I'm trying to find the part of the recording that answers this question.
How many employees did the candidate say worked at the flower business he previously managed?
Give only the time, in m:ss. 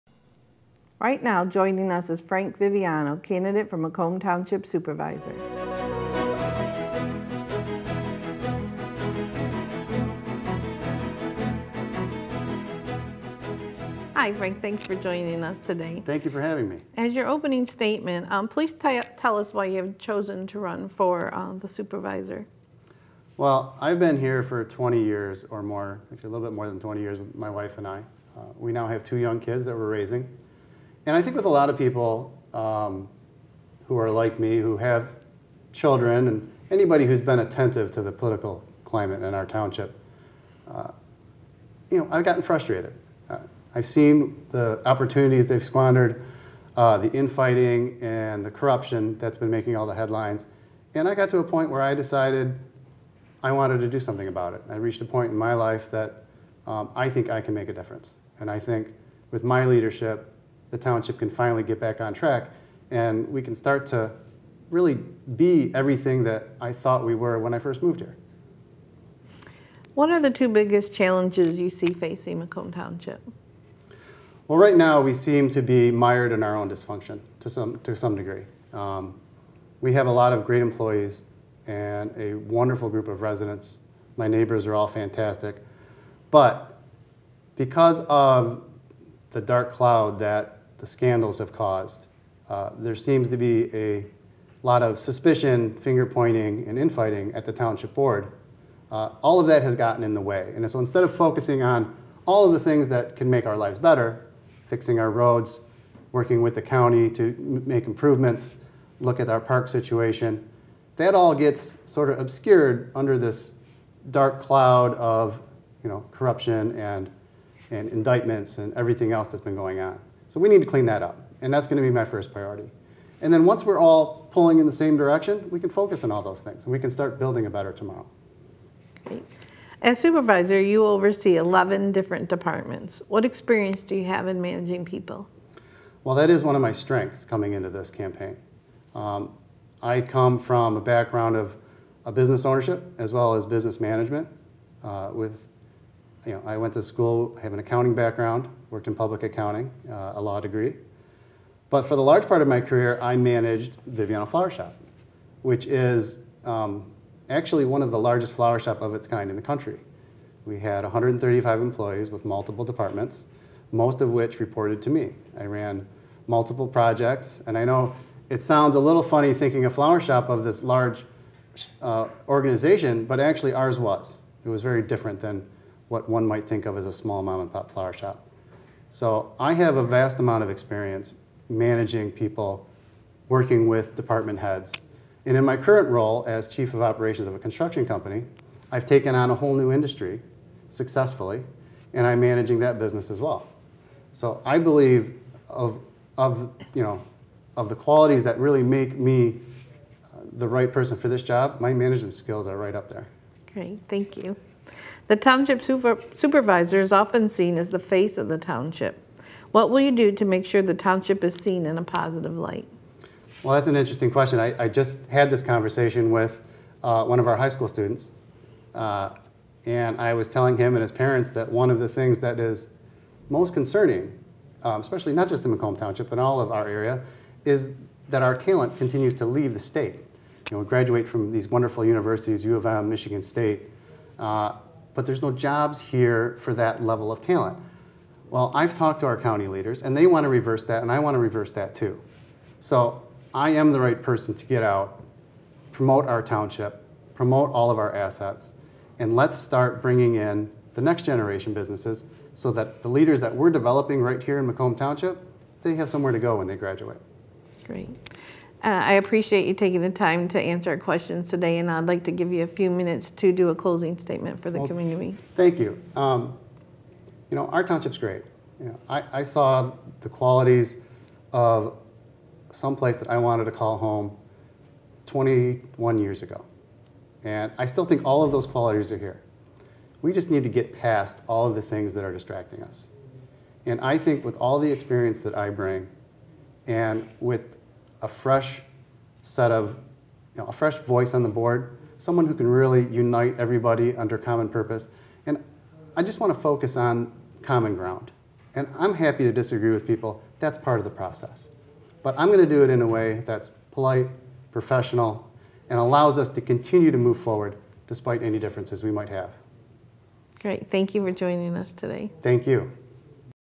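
2:40.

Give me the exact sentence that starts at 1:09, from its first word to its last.
What are the two biggest challenges you see facing Macomb Township?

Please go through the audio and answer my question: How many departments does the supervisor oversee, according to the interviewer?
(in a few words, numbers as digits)
11.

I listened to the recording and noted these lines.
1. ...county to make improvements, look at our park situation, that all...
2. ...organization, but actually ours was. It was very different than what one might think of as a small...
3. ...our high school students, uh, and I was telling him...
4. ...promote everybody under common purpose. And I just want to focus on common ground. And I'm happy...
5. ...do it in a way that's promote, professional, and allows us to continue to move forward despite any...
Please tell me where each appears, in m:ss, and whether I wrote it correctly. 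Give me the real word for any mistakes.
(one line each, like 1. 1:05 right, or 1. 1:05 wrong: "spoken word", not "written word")
1. 1:46 right
2. 2:52 right
3. 3:37 right
4. 4:52 wrong: "unite", not "promote"
5. 5:02 wrong: "polite", not "promote".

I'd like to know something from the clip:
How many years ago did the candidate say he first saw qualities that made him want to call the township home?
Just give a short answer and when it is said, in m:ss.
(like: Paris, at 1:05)
21, at 4:35.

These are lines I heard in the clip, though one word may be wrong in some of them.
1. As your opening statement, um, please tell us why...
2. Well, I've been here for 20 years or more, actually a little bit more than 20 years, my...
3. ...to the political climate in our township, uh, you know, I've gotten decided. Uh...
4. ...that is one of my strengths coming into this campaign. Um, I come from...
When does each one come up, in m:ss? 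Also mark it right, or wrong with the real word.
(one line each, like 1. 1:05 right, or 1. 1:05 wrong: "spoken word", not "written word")
1. 0:16 right
2. 0:23 right
3. 0:37 wrong: "frustrated", not "decided"
4. 2:16 right.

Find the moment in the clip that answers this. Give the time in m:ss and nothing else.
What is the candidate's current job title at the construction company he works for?
3:06.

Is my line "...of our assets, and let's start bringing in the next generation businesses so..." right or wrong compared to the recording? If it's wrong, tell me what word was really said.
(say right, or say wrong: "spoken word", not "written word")
right.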